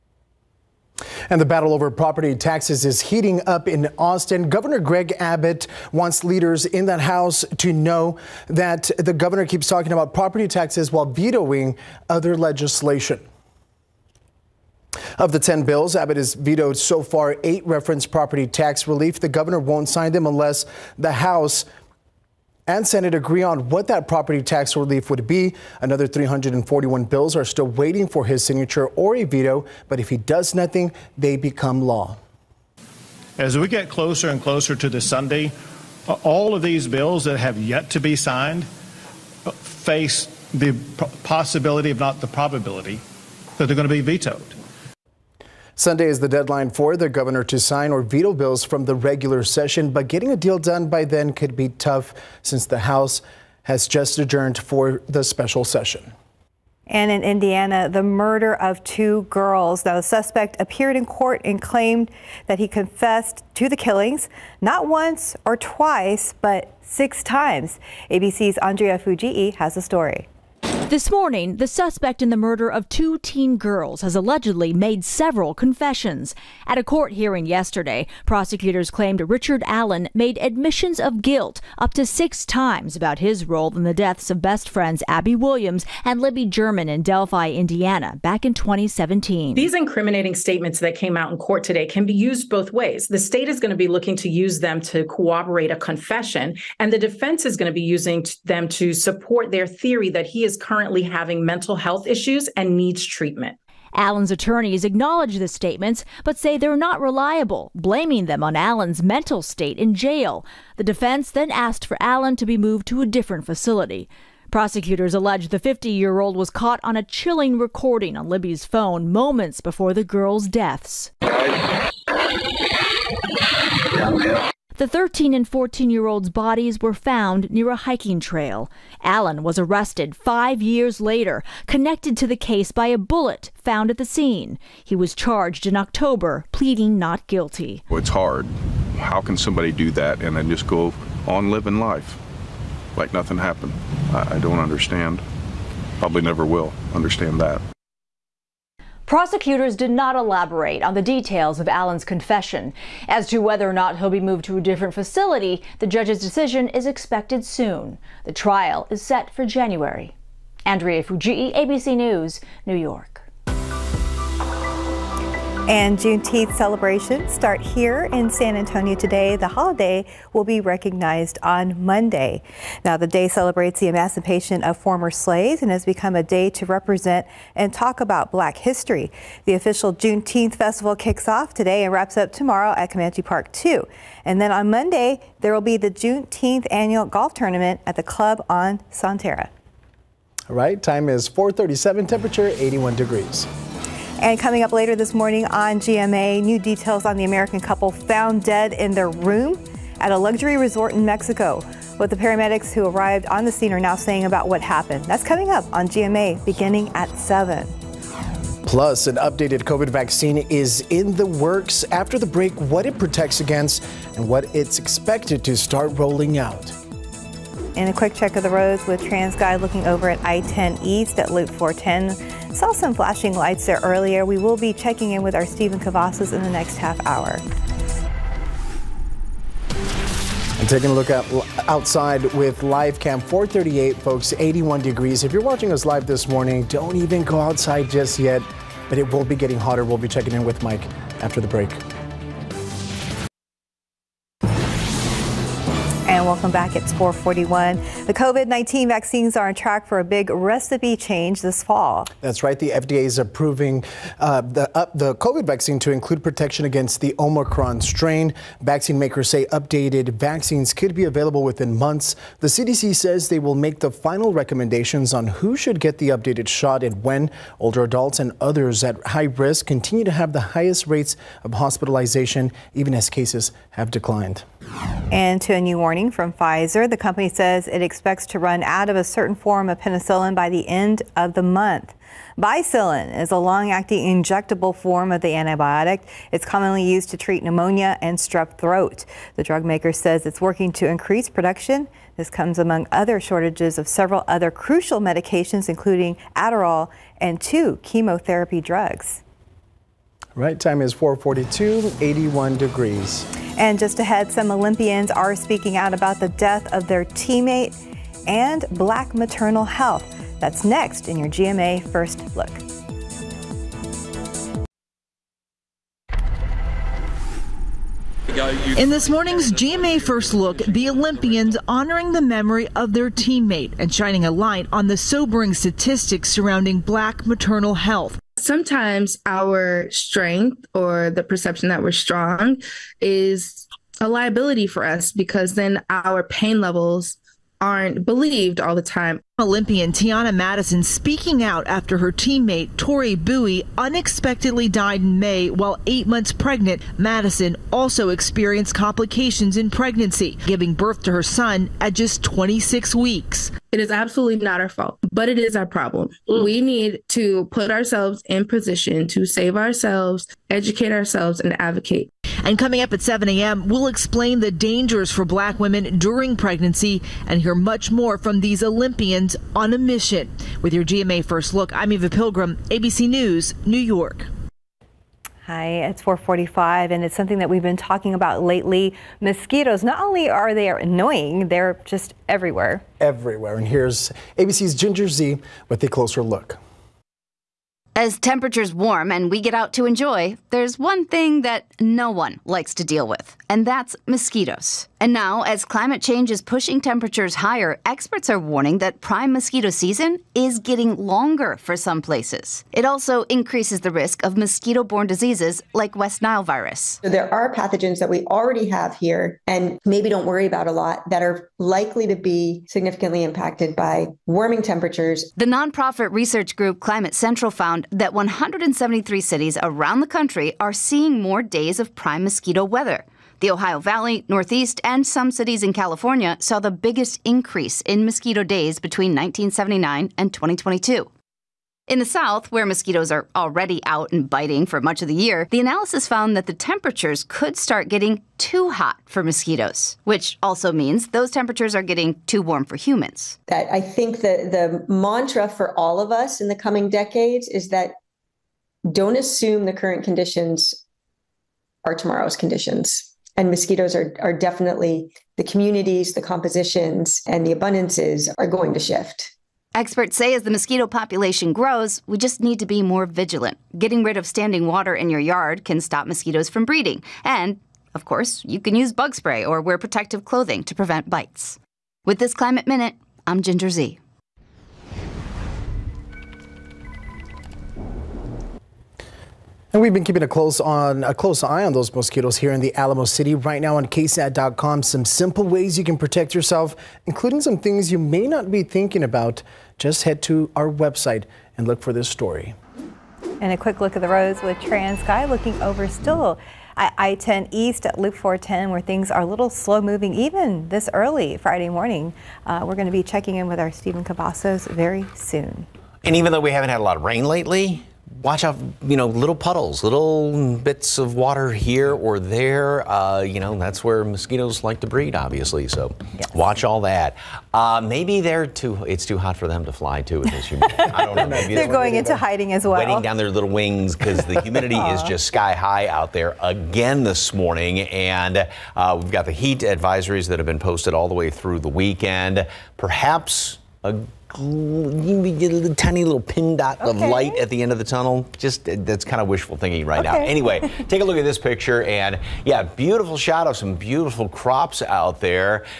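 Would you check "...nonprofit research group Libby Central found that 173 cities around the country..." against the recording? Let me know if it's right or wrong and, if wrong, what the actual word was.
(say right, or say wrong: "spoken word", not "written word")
wrong: "Climate", not "Libby".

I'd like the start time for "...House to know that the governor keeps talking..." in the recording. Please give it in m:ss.
0:07.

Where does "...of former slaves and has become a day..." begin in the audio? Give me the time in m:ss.
2:54.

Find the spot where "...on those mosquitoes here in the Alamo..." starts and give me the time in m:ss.
8:01.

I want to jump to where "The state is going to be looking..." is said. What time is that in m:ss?
1:33.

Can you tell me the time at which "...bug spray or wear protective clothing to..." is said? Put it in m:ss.
7:48.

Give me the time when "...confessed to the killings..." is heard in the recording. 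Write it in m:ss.
1:02.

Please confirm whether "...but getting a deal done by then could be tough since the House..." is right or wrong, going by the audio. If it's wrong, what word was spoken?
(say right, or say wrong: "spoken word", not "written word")
right.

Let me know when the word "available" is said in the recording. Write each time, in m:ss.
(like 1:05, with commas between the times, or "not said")
4:21.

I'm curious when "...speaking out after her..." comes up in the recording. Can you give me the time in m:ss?
5:40.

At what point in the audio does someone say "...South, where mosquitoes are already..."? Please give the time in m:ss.
7:12.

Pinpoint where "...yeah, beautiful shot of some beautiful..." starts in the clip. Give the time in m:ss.
9:02.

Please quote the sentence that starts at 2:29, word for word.
Prosecutors did not elaborate on the details of Allen's confession.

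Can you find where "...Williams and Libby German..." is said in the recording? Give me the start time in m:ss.
1:25.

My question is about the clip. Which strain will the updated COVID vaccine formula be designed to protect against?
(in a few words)
Omicron.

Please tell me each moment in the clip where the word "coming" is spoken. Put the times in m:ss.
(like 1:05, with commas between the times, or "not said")
3:14, 3:25, 6:02, 7:26.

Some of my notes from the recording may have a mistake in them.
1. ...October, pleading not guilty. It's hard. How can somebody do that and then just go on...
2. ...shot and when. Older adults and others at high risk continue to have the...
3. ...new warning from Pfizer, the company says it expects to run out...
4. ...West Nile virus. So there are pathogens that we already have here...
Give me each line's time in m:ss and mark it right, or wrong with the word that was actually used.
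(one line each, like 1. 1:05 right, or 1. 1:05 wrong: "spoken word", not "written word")
1. 2:15 right
2. 4:26 right
3. 4:35 right
4. 6:45 right.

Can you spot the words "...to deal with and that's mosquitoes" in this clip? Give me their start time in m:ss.
6:32.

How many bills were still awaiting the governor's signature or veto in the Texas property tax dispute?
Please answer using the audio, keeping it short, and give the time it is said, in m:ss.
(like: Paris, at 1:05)
341, at 0:26.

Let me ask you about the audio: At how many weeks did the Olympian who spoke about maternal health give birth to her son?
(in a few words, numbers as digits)
26 weeks.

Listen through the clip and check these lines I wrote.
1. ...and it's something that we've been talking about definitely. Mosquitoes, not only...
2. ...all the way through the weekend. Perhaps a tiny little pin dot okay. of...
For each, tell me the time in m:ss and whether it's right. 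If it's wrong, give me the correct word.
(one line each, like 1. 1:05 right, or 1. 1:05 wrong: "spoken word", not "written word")
1. 6:16 wrong: "lately", not "definitely"
2. 8:50 right.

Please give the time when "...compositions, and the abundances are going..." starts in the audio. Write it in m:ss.
7:36.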